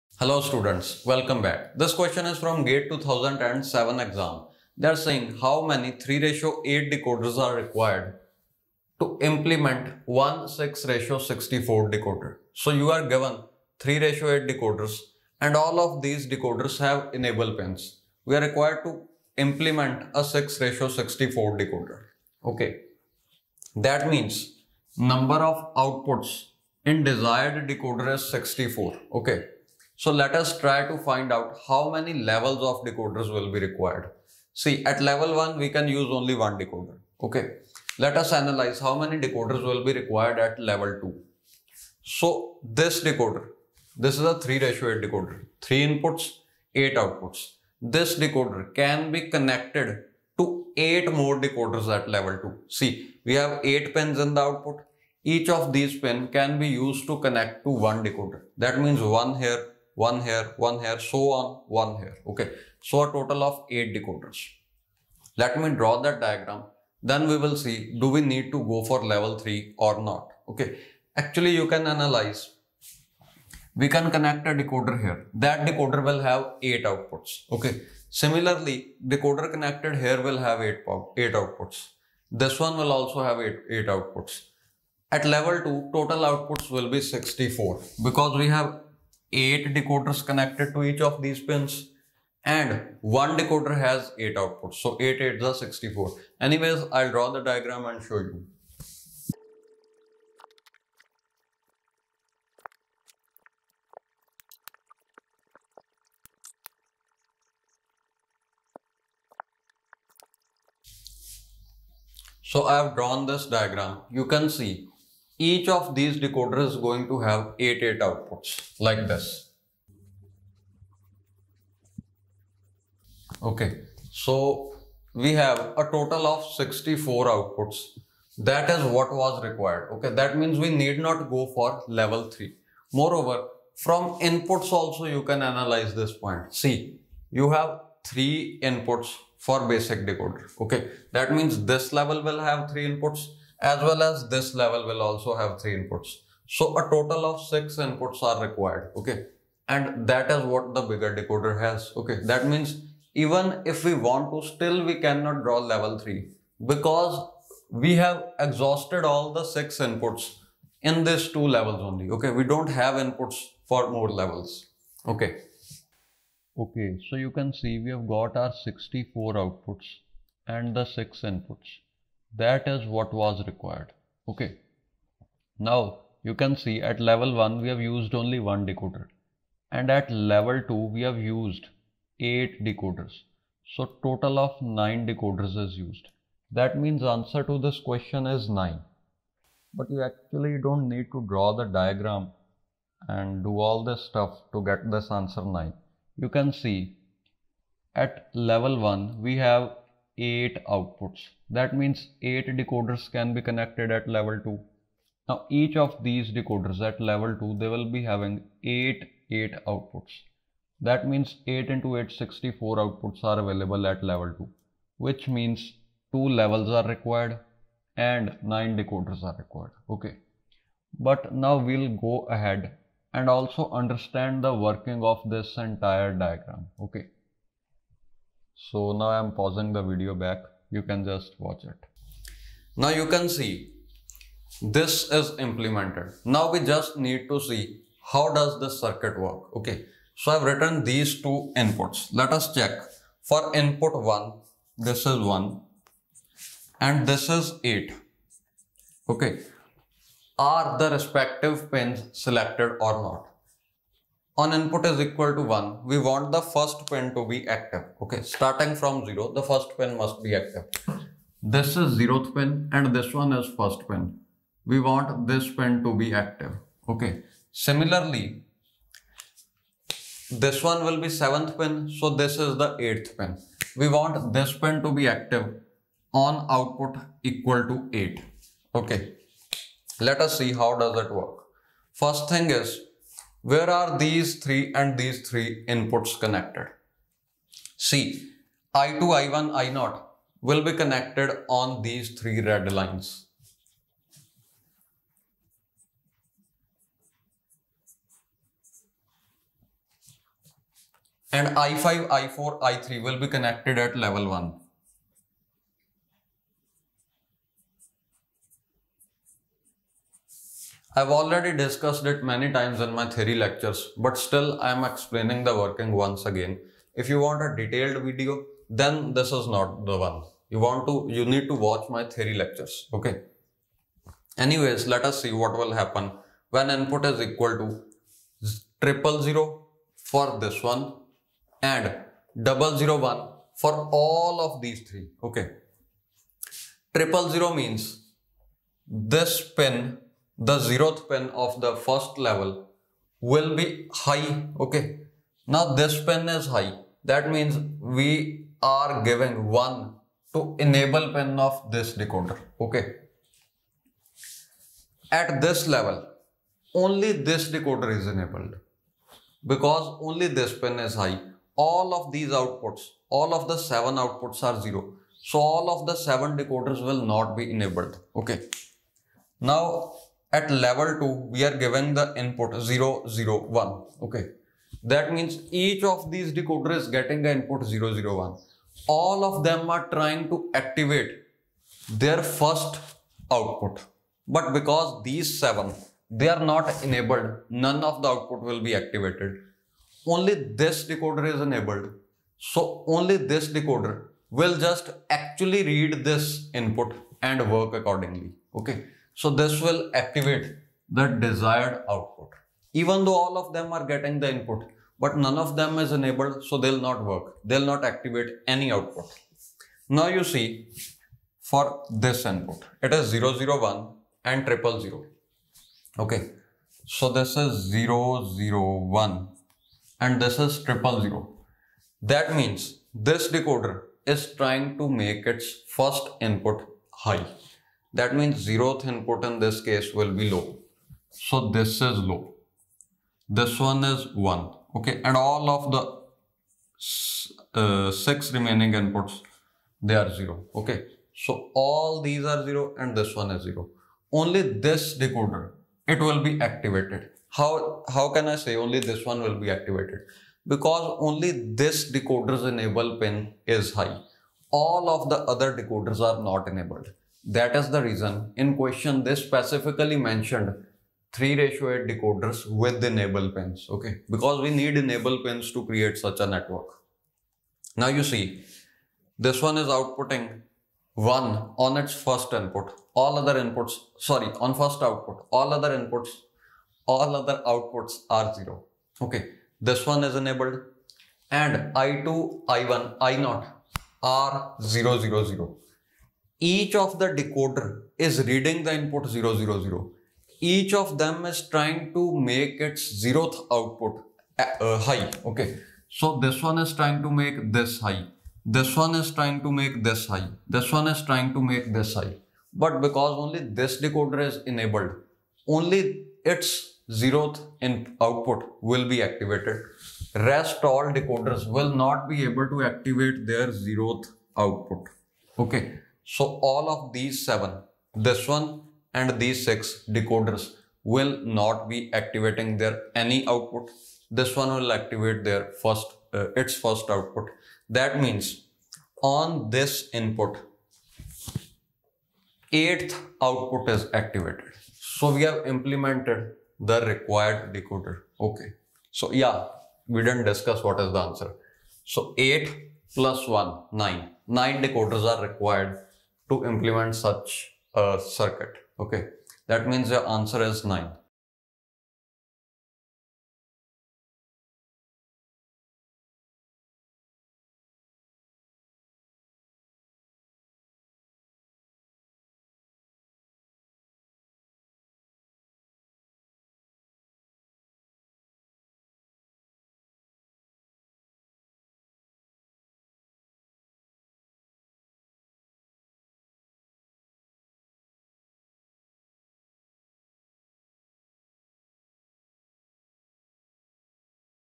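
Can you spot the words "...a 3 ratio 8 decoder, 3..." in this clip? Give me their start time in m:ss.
0:44.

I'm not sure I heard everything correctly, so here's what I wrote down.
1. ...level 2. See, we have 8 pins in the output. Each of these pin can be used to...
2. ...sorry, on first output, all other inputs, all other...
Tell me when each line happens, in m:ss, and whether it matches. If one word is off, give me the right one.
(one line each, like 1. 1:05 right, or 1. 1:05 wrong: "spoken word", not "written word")
1. 0:52 right
2. 7:53 right.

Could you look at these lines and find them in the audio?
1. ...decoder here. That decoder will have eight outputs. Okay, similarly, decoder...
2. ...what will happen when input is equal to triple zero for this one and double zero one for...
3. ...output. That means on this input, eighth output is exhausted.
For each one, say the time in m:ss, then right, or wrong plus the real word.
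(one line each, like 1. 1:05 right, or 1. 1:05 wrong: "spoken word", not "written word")
1. 1:14 right
2. 5:25 right
3. 8:46 wrong: "activated", not "exhausted".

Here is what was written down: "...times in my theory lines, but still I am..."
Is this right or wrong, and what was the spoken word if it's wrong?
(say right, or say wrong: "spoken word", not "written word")
wrong: "lectures", not "lines".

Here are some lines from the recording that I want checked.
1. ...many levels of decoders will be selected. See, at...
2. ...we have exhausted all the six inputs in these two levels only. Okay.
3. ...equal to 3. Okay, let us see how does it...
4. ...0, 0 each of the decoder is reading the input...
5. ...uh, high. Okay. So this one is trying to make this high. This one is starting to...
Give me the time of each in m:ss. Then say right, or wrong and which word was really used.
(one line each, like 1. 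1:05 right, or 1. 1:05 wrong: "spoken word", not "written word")
1. 0:31 wrong: "required", not "selected"
2. 2:37 right
3. 4:37 wrong: "8", not "3"
4. 8:04 right
5. 8:14 wrong: "trying", not "starting".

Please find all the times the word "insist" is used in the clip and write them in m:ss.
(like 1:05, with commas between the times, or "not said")
not said.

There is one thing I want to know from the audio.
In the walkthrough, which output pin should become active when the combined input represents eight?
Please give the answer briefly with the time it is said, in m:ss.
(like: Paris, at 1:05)
8th pin, at 4:32.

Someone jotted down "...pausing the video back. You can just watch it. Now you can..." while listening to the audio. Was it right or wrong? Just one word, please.
right.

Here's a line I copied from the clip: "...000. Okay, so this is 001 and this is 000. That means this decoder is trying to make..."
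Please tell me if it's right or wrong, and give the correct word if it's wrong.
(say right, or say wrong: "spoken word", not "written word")
right.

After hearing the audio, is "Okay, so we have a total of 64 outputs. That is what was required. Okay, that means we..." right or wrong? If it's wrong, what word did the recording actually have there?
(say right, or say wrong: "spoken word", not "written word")
right.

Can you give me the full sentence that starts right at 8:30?
Rest all decoders will not be able to activate their zeroth output.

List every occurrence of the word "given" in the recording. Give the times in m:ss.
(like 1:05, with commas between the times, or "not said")
0:13, 6:11.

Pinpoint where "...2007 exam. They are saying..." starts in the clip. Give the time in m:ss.
0:02.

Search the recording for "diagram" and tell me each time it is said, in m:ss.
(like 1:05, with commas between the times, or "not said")
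1:06, 1:37, 1:53, 3:11, 3:46.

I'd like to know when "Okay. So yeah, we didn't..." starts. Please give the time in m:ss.
8:58.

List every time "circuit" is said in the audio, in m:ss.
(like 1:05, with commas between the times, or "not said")
3:58, 9:08.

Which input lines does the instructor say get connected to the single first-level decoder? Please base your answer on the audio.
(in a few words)
I5, I4, I3.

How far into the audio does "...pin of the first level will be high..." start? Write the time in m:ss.
5:41.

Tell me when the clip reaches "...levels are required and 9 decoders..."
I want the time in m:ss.
3:36.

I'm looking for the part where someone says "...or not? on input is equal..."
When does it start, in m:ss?
4:12.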